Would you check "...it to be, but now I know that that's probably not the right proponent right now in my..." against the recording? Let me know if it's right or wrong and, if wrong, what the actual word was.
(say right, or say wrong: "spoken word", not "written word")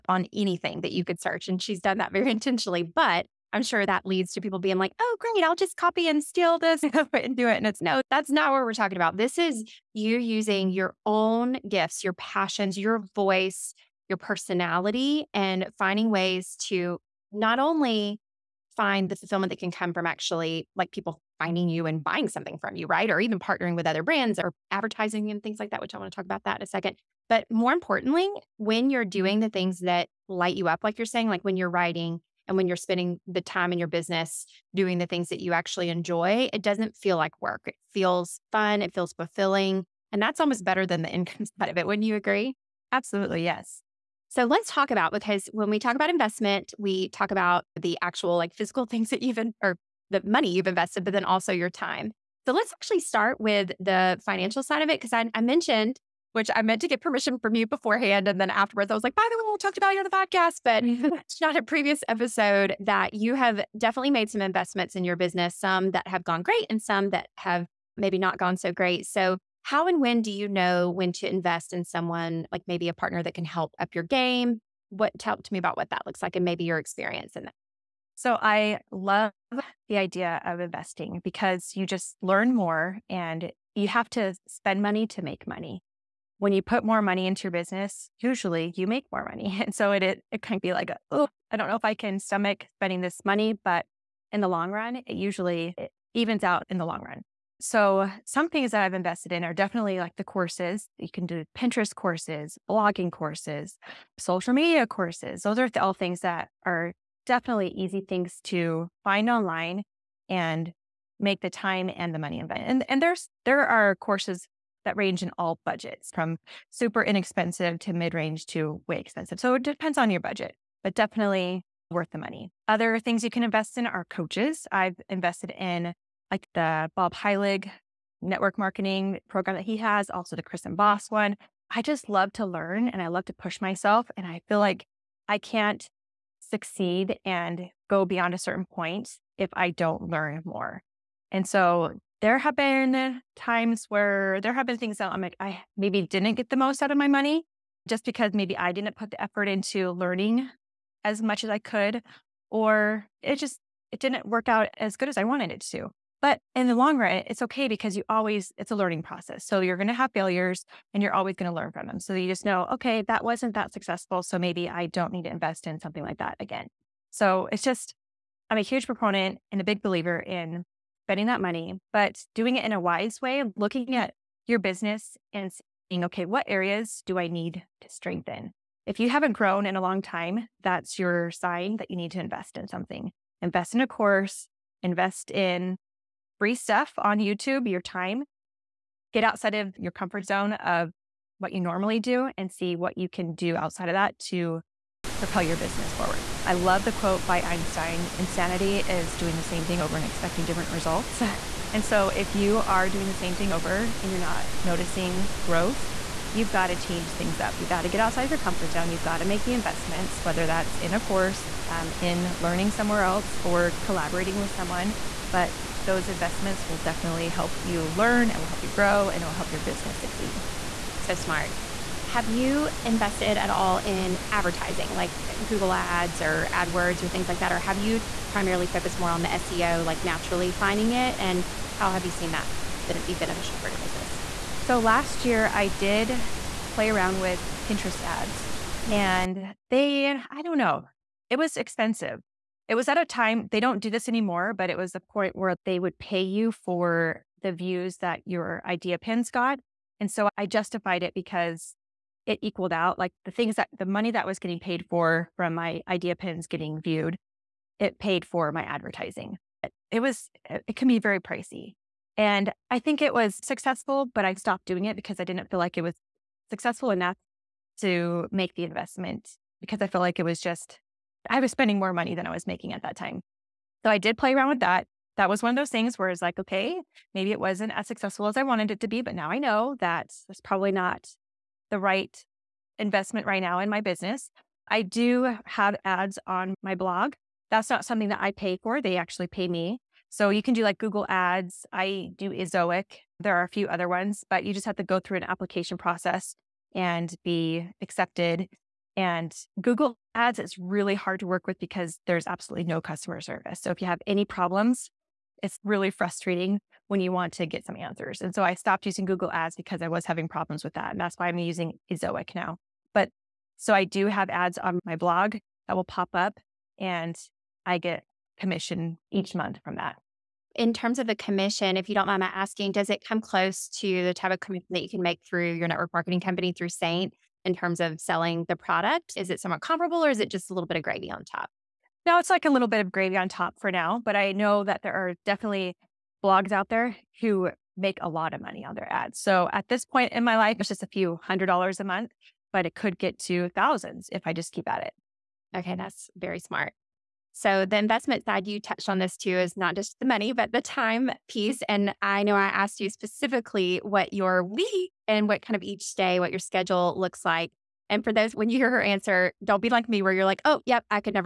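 wrong: "investment", not "proponent".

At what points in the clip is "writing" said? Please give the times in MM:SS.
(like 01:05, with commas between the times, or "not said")
00:31.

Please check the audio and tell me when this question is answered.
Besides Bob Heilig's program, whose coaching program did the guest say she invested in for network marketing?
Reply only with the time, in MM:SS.
02:10.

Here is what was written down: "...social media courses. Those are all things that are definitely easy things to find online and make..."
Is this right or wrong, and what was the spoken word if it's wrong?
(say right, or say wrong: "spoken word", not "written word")
right.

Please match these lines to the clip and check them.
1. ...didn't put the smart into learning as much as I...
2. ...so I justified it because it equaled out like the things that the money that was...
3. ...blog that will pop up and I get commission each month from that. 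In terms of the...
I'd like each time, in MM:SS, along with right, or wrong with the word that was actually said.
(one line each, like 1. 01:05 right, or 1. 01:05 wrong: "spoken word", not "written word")
1. 02:28 wrong: "effort", not "smart"
2. 04:10 right
3. 05:14 right.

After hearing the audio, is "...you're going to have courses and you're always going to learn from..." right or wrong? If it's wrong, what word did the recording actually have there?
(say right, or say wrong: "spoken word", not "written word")
wrong: "failures", not "courses".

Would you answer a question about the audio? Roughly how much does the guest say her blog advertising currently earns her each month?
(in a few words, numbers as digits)
a few hundred dollars.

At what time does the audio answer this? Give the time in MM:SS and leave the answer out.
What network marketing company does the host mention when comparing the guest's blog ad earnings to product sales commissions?
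05:26.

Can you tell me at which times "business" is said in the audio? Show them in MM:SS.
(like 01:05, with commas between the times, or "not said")
00:33, 01:05, 01:27, 02:54, 03:15, 03:39, 03:53, 04:43.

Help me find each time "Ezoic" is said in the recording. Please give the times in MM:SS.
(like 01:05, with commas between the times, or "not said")
04:52, 05:11.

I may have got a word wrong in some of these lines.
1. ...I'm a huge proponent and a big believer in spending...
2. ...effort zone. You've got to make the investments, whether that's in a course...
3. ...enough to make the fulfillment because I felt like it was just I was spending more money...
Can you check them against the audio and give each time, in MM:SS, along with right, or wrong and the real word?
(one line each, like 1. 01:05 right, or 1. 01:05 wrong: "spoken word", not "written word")
1. 02:48 right
2. 03:28 wrong: "comfort", not "effort"
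3. 04:26 wrong: "investment", not "fulfillment".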